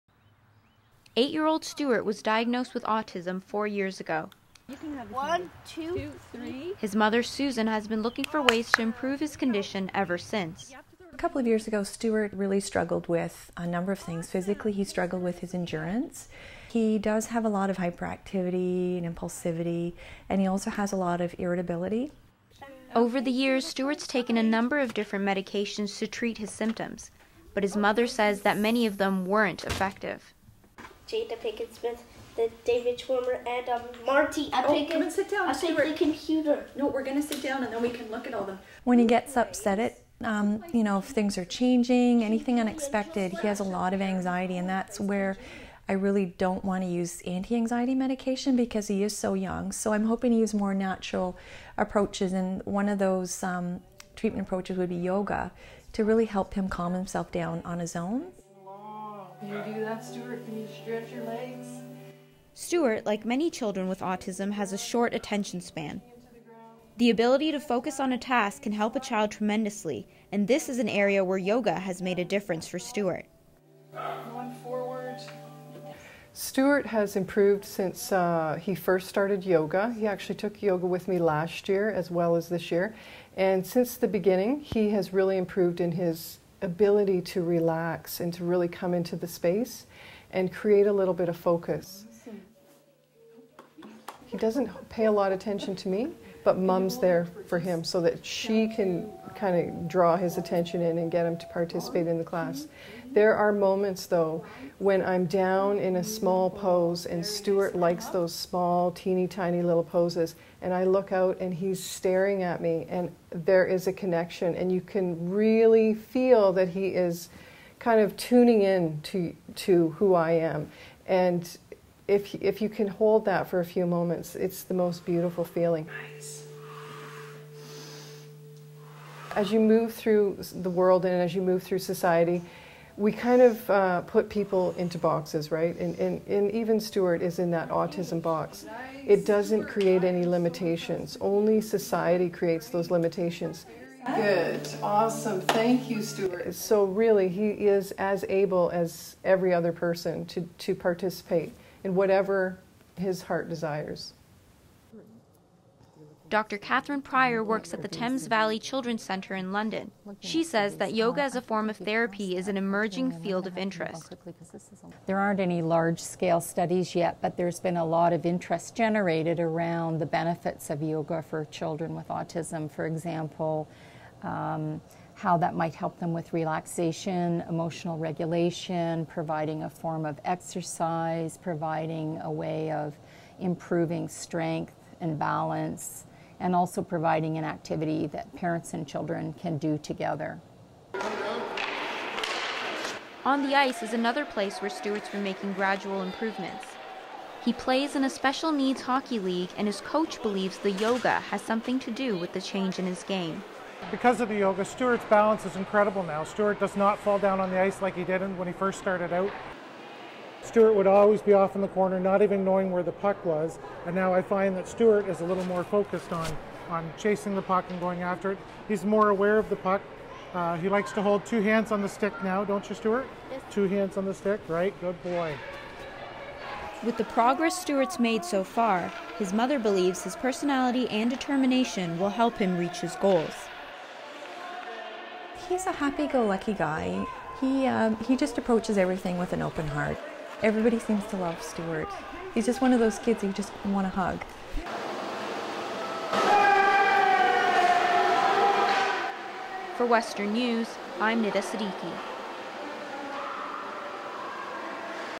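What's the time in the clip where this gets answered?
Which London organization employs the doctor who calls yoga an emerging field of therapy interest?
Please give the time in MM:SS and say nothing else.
02:37.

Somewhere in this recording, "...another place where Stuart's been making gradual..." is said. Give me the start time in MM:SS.
03:13.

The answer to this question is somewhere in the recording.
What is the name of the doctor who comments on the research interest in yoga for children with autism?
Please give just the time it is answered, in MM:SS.
02:36.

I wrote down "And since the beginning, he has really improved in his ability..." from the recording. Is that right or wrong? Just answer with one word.
right.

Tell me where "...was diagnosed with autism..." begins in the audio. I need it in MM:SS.
00:02.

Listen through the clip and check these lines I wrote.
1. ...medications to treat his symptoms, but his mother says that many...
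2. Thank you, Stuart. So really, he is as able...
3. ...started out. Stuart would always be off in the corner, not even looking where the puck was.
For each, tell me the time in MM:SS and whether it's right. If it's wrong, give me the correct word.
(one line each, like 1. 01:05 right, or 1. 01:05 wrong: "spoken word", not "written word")
1. 00:25 right
2. 02:25 right
3. 03:28 wrong: "knowing", not "looking".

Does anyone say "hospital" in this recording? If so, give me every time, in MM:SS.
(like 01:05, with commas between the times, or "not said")
not said.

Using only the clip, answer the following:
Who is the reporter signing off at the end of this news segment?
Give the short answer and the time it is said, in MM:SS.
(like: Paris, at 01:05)
Nida Siddiqui, at 04:11.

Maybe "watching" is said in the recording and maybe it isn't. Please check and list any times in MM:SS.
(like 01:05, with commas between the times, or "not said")
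not said.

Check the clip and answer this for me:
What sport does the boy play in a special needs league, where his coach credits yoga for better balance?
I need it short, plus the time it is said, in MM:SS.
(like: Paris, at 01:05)
Hockey, at 03:18.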